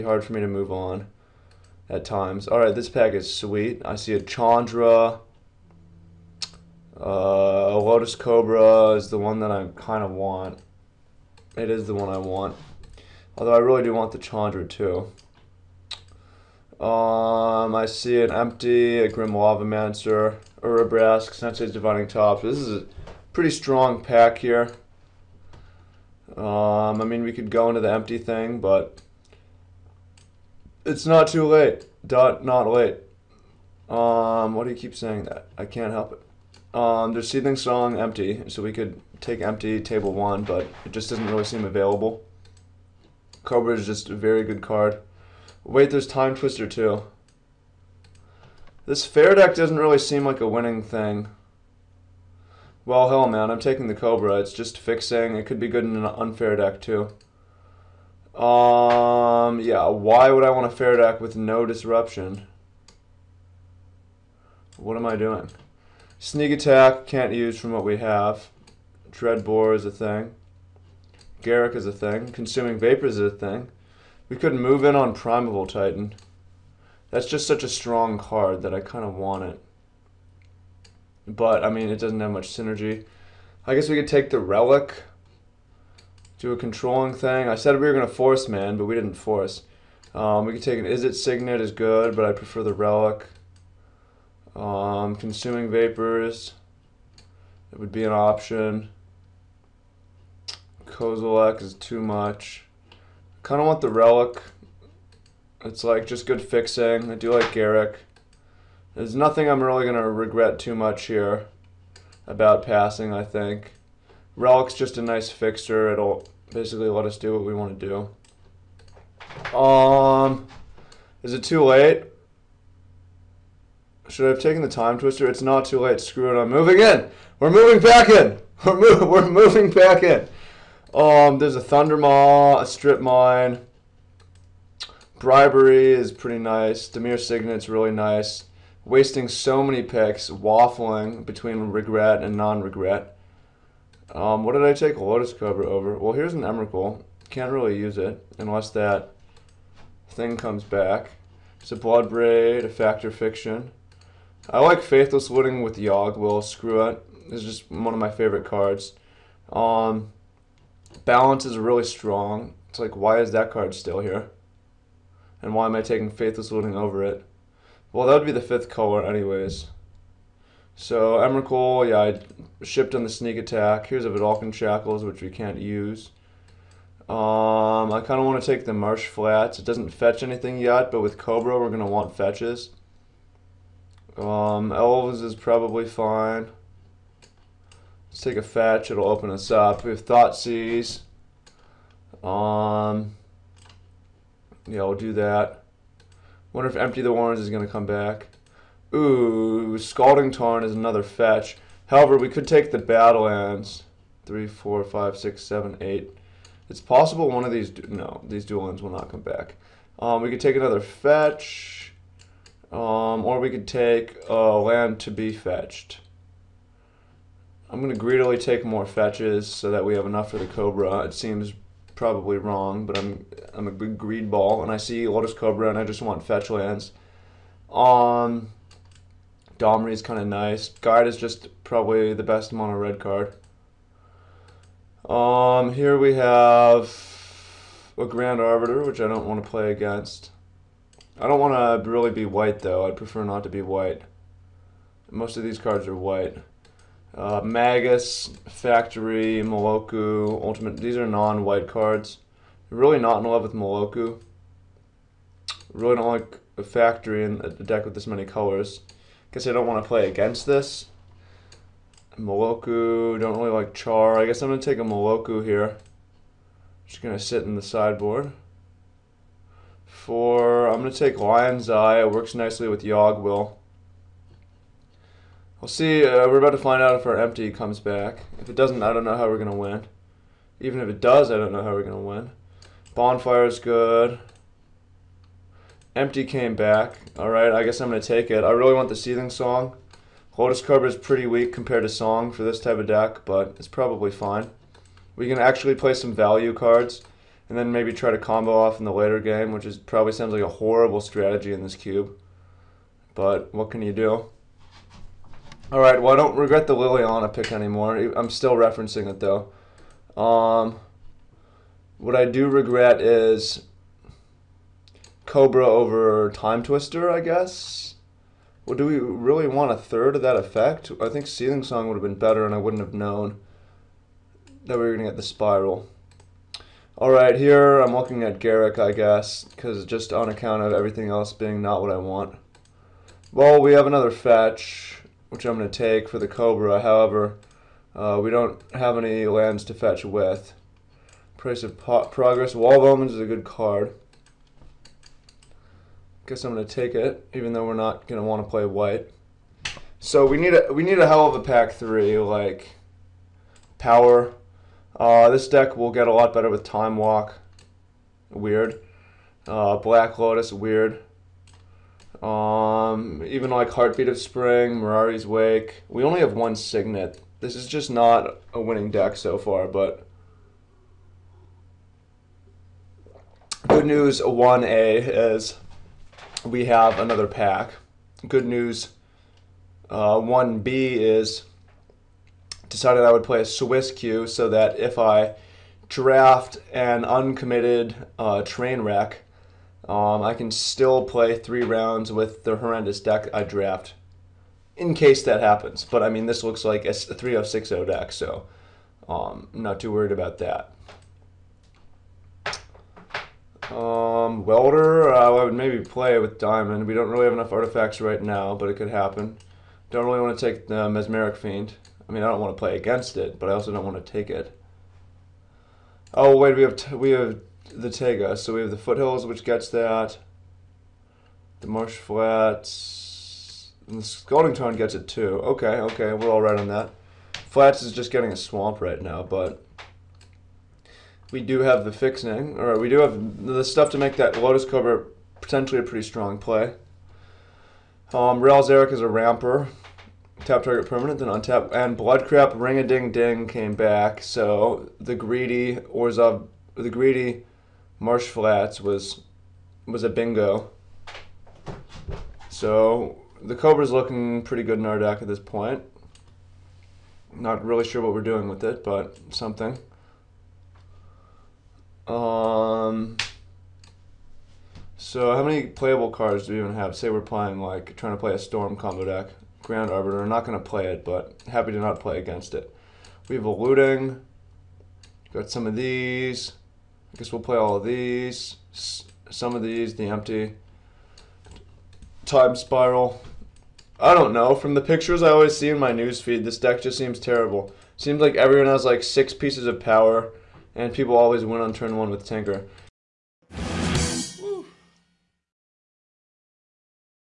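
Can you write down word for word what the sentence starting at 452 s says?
So the Cobra's looking pretty good in our deck at this point.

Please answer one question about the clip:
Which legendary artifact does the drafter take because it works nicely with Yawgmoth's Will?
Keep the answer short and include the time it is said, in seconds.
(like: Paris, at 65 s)
Lion's Eye, at 271 s.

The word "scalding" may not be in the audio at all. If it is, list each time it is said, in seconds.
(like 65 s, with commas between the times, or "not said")
199 s, 424 s.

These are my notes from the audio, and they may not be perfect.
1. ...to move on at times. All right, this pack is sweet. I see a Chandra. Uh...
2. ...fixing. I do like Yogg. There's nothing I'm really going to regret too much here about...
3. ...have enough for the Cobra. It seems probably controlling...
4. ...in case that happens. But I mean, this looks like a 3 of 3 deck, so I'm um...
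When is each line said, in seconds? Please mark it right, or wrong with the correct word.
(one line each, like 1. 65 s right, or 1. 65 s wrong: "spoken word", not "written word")
1. 0 s right
2. 106 s wrong: "Garruk", not "Yogg"
3. 219 s wrong: "wrong", not "controlling"
4. 394 s wrong: "6", not "3".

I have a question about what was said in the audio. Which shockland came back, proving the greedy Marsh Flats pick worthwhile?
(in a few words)
Blood Crypt.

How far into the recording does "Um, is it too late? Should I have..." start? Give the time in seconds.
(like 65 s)
119 s.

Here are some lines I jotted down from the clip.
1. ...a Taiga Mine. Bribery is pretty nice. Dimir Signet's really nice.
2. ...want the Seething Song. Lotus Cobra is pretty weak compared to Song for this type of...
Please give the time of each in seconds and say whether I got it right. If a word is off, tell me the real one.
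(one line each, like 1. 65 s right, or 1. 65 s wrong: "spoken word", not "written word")
1. 132 s wrong: "Strip", not "Taiga"
2. 288 s right.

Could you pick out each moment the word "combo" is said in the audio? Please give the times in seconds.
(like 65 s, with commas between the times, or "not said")
298 s, 468 s.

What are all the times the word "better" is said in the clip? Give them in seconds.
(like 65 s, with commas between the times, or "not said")
322 s, 356 s.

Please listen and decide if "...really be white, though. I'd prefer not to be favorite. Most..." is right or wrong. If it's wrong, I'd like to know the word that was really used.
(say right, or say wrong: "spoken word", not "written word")
wrong: "white", not "favorite".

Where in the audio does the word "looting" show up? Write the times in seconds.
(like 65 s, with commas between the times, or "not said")
155 s, 166 s, 473 s.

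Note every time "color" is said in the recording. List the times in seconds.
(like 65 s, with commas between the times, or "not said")
168 s, 258 s.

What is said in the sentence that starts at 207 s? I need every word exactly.
No, these dual ends will not come back.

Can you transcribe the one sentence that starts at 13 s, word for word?
Although I really do want the Chandra too.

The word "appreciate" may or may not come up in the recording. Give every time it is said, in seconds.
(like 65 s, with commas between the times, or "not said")
not said.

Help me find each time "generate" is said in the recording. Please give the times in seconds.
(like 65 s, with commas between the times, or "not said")
not said.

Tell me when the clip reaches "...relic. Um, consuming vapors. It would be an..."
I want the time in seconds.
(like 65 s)
92 s.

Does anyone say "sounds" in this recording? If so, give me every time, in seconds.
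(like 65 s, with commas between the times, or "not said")
300 s.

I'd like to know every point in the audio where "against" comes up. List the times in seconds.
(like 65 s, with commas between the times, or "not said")
239 s, 260 s, 412 s, 472 s.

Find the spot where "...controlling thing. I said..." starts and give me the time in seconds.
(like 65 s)
86 s.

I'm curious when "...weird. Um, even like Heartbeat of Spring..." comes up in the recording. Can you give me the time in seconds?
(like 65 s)
360 s.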